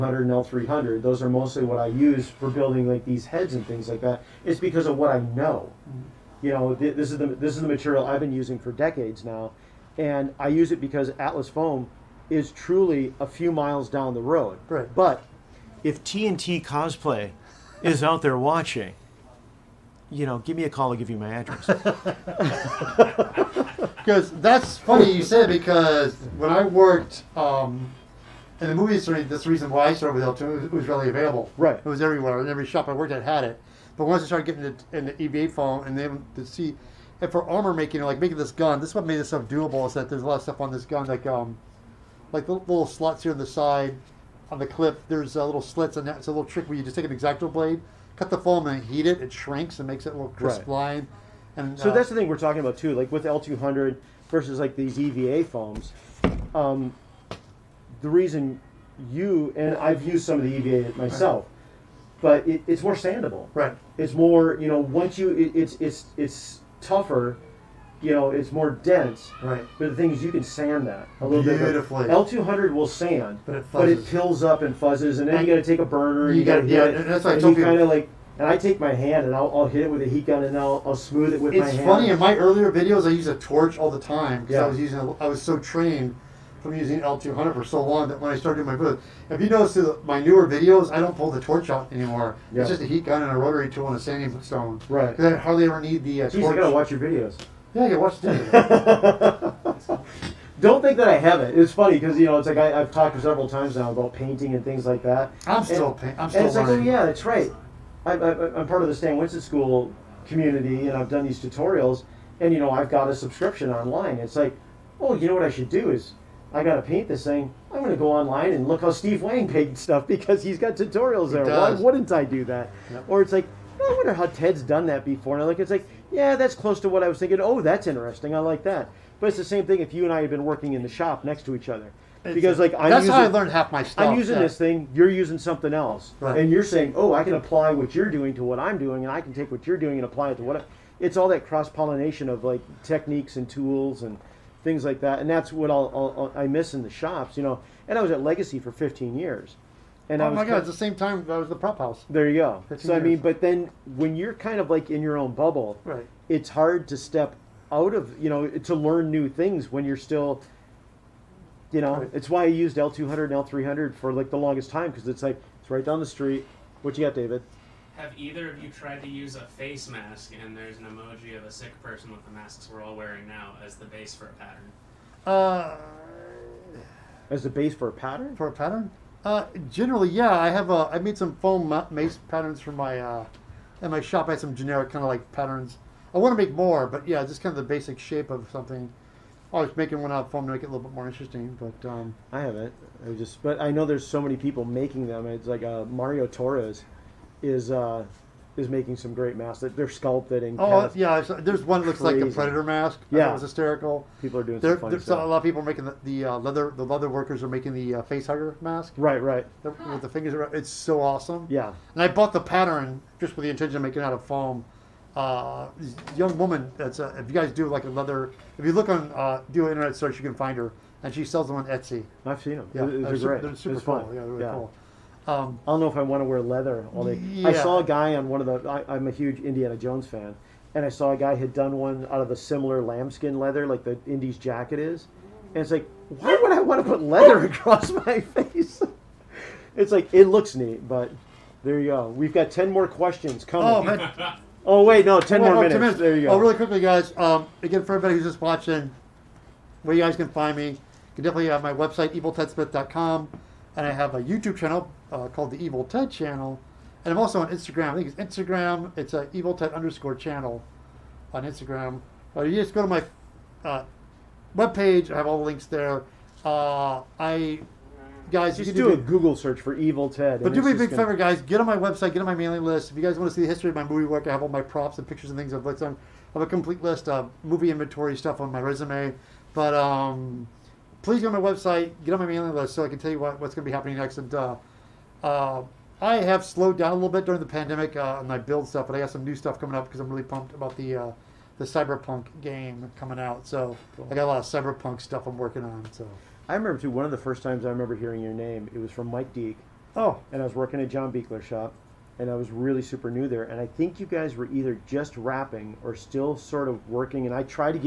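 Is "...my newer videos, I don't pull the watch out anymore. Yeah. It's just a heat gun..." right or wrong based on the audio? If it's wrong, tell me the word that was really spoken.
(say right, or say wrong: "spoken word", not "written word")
wrong: "torch", not "watch".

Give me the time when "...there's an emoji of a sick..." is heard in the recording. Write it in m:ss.
2:50.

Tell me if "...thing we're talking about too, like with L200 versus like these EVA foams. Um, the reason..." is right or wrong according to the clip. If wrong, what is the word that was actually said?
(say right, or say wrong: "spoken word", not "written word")
right.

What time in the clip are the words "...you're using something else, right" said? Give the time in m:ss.
2:14.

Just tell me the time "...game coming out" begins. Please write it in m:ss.
4:52.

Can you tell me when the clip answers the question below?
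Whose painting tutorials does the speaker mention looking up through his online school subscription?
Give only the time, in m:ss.
1:58.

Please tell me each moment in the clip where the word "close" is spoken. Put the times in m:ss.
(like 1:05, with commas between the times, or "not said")
2:06.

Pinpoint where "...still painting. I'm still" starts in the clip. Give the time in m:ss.
1:45.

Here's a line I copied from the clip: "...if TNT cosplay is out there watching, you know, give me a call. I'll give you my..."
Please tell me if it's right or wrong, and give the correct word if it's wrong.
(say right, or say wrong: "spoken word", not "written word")
right.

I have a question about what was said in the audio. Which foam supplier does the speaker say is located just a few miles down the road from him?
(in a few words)
Atlas foam.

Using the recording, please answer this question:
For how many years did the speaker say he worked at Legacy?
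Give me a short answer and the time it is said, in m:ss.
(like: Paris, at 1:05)
15, at 2:28.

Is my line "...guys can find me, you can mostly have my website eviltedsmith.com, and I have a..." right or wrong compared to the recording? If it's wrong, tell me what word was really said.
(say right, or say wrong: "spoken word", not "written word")
wrong: "definitely", not "mostly".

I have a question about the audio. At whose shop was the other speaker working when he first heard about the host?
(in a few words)
John Buechler.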